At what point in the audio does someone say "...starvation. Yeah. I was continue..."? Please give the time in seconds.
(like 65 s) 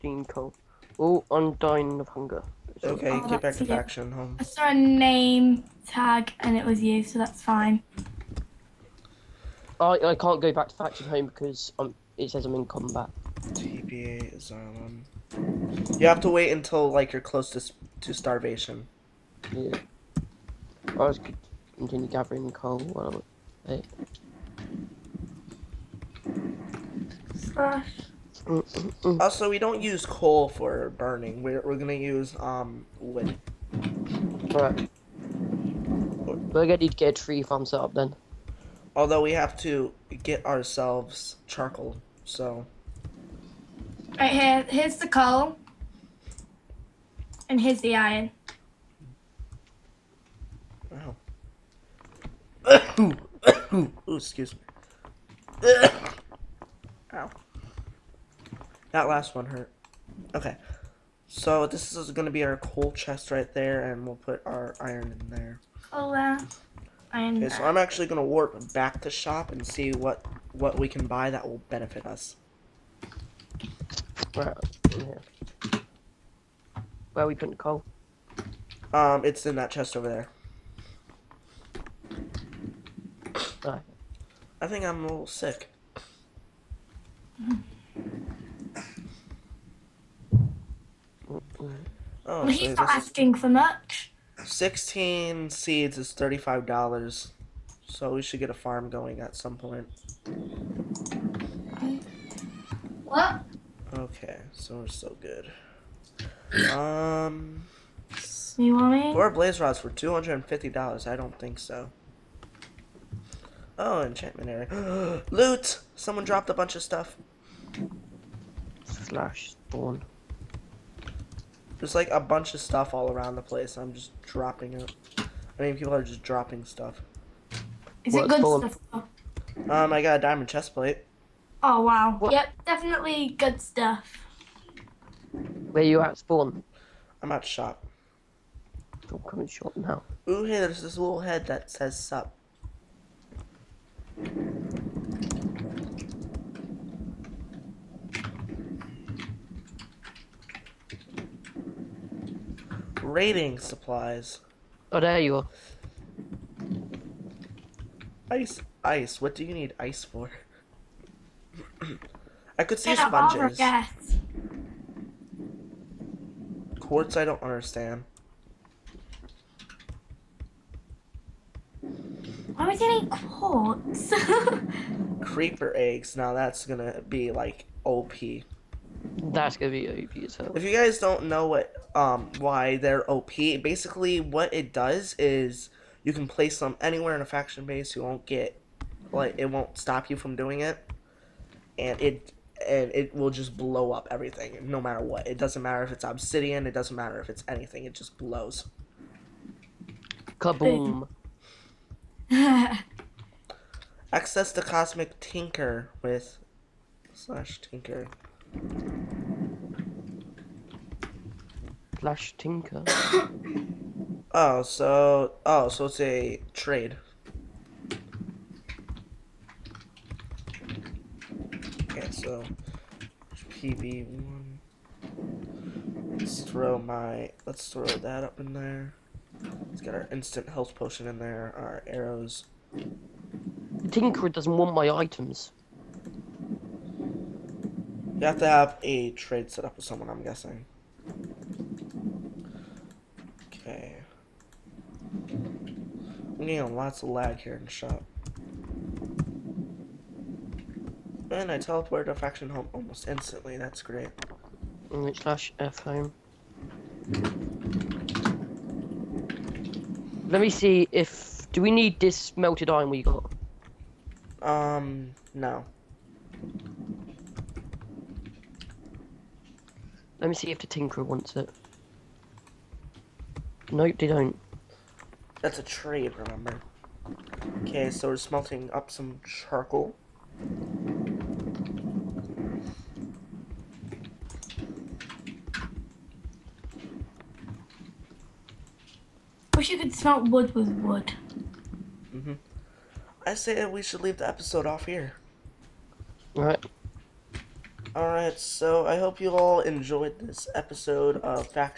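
18 s.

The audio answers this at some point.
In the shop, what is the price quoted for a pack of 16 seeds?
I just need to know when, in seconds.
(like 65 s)
96 s.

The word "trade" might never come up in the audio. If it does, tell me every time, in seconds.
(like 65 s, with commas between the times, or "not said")
216 s, 239 s, 275 s.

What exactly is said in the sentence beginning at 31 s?
We're we're gonna use um wood.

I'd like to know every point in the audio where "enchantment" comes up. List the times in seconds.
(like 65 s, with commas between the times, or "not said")
114 s.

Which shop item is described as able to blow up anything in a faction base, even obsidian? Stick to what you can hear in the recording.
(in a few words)
Creeper eggs.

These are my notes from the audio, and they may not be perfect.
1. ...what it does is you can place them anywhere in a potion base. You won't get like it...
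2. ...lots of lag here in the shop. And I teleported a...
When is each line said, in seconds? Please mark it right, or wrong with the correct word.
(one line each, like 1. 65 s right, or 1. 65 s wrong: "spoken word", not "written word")
1. 184 s wrong: "faction", not "potion"
2. 246 s right.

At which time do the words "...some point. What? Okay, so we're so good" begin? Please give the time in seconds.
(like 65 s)
99 s.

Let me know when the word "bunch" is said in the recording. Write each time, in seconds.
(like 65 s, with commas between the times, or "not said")
116 s, 122 s.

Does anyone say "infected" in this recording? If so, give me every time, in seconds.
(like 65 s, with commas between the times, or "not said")
not said.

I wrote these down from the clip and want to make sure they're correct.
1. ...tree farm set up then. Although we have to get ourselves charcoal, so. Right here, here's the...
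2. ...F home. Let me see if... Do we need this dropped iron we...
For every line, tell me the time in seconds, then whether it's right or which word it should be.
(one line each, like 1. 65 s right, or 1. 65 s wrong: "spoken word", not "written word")
1. 37 s right
2. 255 s wrong: "melted", not "dropped".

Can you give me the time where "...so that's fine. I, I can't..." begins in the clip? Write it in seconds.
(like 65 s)
7 s.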